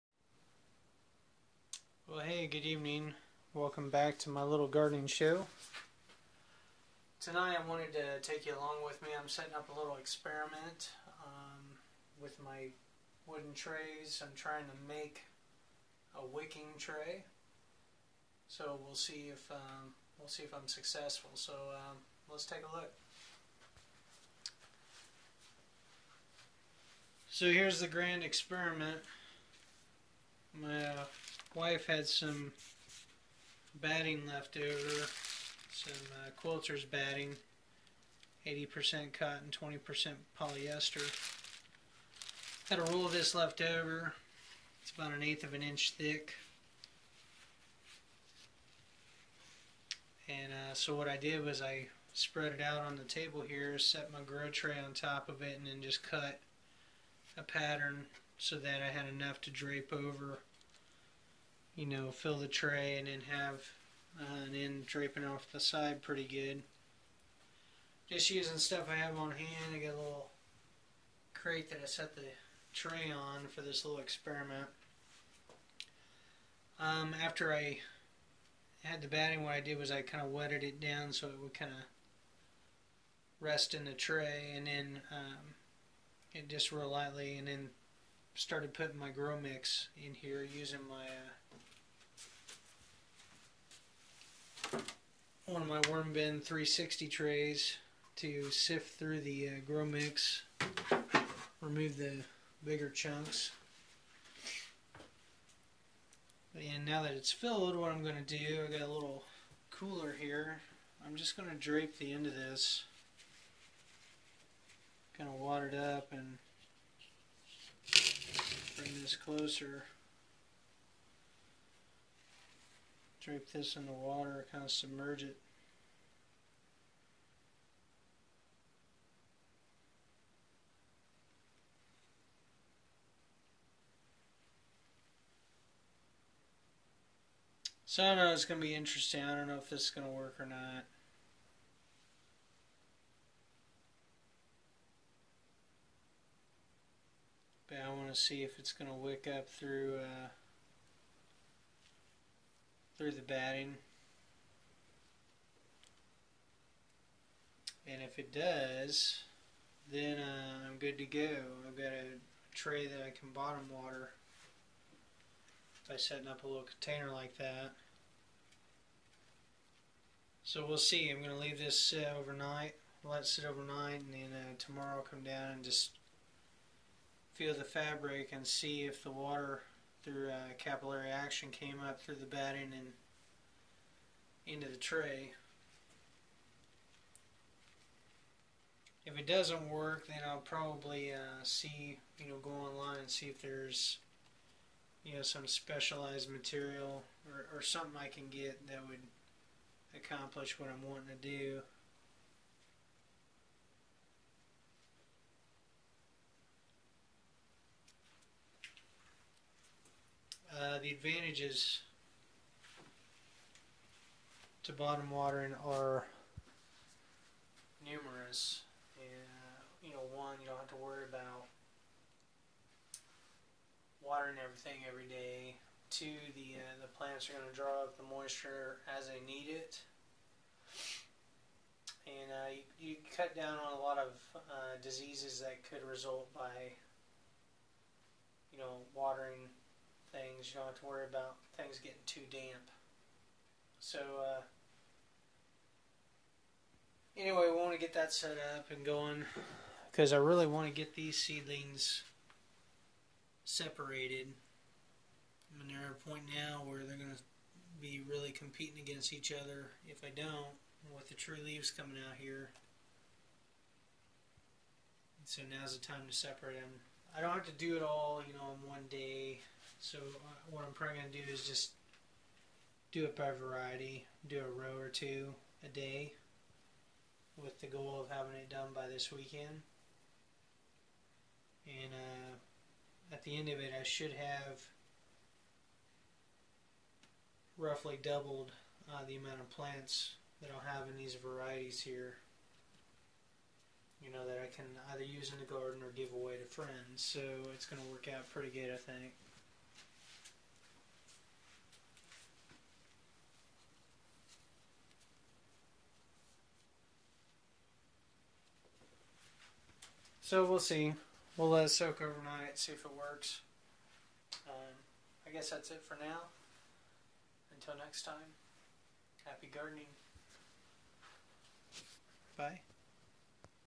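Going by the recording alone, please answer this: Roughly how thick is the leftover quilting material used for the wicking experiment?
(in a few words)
an eighth of an inch.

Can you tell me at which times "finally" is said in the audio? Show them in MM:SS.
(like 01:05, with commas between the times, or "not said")
not said.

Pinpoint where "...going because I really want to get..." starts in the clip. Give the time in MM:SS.
04:08.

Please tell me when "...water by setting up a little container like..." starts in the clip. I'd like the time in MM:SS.
02:43.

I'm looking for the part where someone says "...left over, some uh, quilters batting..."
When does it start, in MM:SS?
00:34.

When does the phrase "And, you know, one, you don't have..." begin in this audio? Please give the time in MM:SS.
03:38.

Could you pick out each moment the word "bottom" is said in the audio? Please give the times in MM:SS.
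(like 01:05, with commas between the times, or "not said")
02:43, 03:34.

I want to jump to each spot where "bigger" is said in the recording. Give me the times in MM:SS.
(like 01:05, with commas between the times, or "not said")
01:42.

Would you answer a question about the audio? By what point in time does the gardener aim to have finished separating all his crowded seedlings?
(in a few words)
this weekend.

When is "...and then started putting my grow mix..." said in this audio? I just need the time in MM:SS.
01:27.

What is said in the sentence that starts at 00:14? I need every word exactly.
I'm trying to make a wicking tray.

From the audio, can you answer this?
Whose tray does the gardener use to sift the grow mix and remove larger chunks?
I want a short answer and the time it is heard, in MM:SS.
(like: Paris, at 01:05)
worm bin 360, at 01:35.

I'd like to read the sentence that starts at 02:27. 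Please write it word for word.
But I want to see if it's going to wick up through, uh, through the batting.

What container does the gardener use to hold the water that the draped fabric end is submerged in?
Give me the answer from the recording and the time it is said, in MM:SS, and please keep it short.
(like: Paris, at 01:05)
cooler, at 01:49.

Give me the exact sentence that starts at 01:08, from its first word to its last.
Just using stuff I have on hand.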